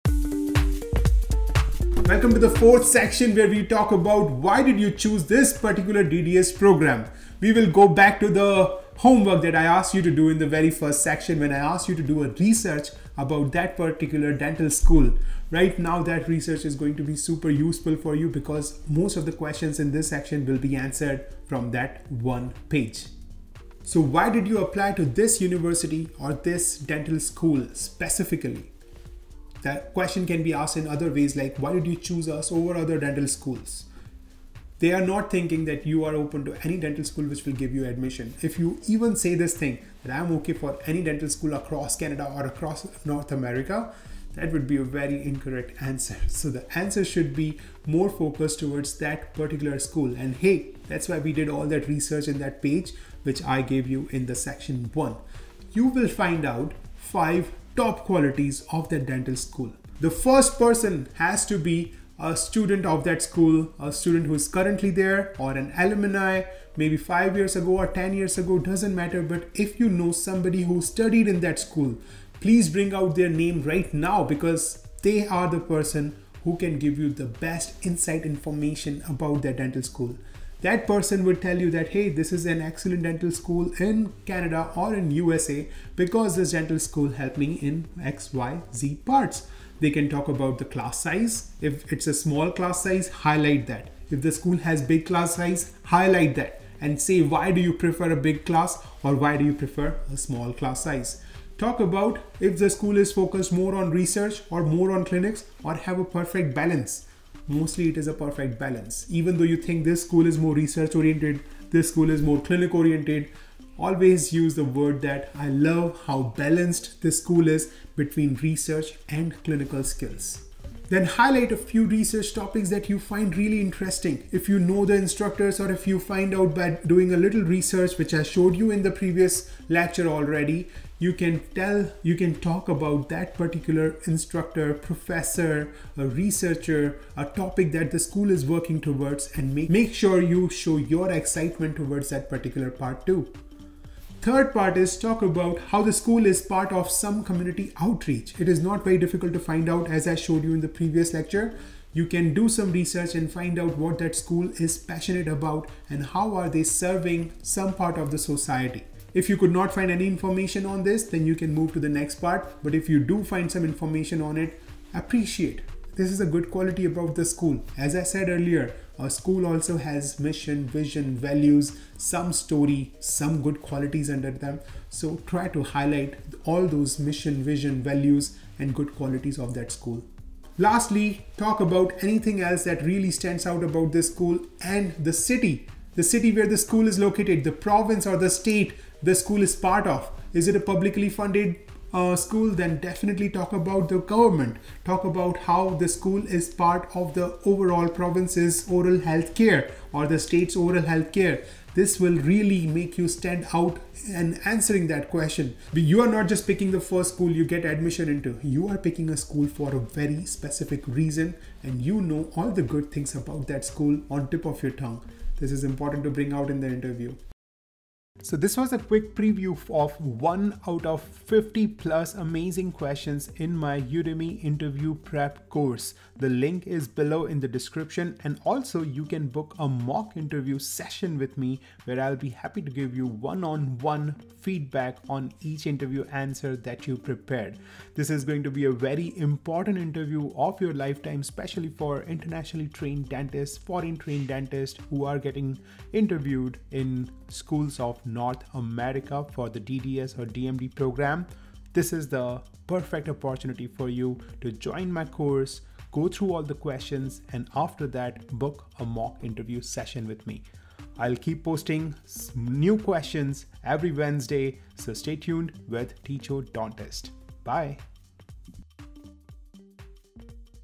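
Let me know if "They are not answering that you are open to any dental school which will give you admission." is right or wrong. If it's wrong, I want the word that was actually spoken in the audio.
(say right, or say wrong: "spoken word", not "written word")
wrong: "thinking", not "answering".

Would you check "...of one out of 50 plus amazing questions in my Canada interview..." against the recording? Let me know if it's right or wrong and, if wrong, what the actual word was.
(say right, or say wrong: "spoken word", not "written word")
wrong: "Udemy", not "Canada".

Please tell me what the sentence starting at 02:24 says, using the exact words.
Third part is talk about how the school is part of some community outreach.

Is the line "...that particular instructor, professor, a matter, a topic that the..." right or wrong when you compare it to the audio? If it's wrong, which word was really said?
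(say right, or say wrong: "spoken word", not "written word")
wrong: "researcher", not "matter".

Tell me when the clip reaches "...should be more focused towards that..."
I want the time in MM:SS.
00:47.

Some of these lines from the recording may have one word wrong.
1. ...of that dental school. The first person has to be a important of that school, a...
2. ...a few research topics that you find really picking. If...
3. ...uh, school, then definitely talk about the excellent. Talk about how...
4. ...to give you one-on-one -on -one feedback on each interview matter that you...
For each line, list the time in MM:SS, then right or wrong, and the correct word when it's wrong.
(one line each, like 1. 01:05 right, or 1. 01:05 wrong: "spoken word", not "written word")
1. 00:58 wrong: "student", not "important"
2. 02:01 wrong: "interesting", not "picking"
3. 03:11 wrong: "government", not "excellent"
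4. 03:52 wrong: "answer", not "matter".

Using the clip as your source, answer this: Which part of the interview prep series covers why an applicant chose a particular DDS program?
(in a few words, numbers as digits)
fourth.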